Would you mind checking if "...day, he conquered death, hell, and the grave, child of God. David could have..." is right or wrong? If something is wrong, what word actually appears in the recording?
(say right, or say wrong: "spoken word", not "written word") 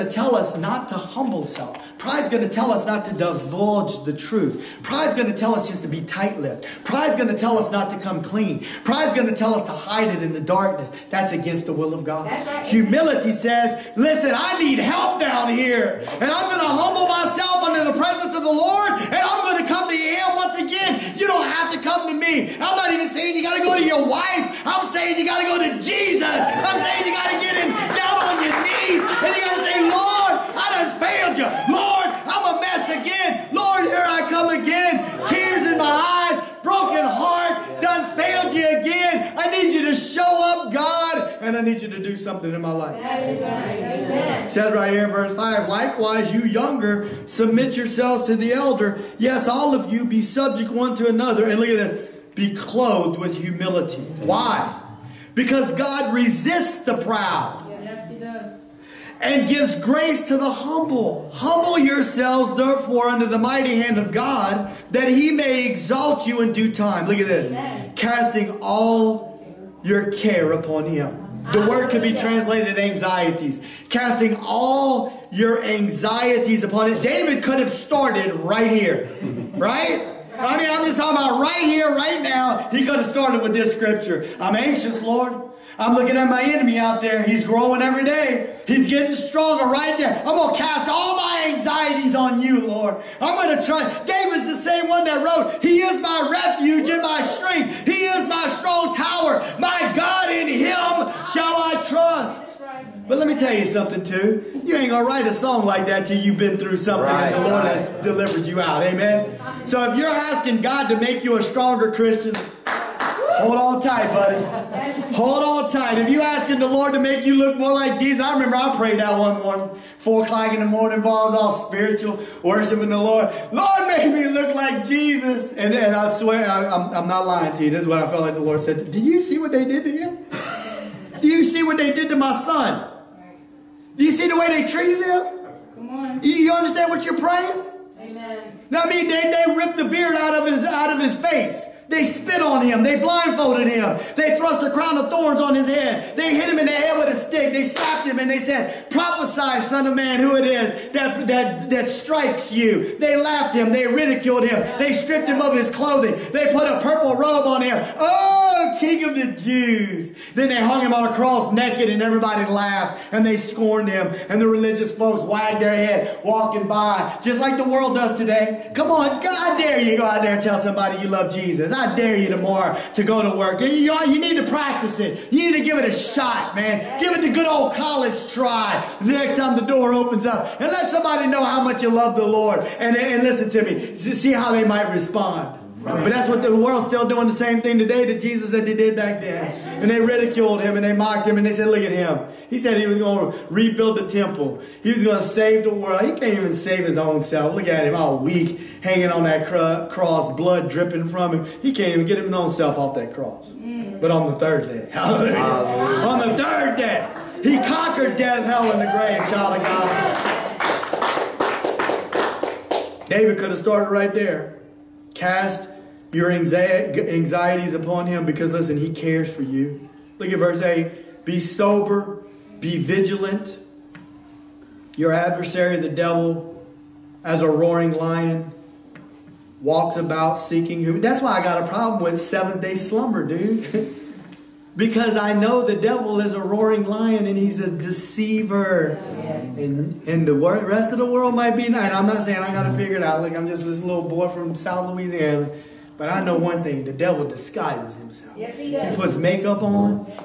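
right.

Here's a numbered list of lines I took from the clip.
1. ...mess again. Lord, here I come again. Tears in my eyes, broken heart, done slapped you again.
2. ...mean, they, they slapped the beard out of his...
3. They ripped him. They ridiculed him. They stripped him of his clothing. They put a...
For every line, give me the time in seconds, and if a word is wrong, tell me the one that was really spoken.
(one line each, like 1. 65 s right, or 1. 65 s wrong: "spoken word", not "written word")
1. 32 s wrong: "failed", not "slapped"
2. 138 s wrong: "ripped", not "slapped"
3. 152 s wrong: "laughed", not "ripped".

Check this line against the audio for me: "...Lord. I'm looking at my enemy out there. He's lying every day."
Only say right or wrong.
wrong.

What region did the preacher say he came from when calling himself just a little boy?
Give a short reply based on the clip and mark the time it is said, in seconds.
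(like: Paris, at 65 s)
South Louisiana, at 244 s.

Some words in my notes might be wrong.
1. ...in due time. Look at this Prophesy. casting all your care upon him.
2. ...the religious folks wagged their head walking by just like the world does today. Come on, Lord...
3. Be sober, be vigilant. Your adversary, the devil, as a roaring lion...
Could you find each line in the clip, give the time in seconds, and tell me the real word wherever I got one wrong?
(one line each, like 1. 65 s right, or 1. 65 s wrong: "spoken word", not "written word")
1. 66 s wrong: "Amen", not "Prophesy"
2. 164 s wrong: "God", not "Lord"
3. 221 s right.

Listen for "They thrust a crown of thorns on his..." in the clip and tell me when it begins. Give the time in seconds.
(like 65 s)
144 s.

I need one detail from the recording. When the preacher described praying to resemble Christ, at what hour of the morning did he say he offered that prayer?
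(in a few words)
4 o'clock.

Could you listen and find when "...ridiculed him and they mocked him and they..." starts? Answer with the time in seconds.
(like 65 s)
190 s.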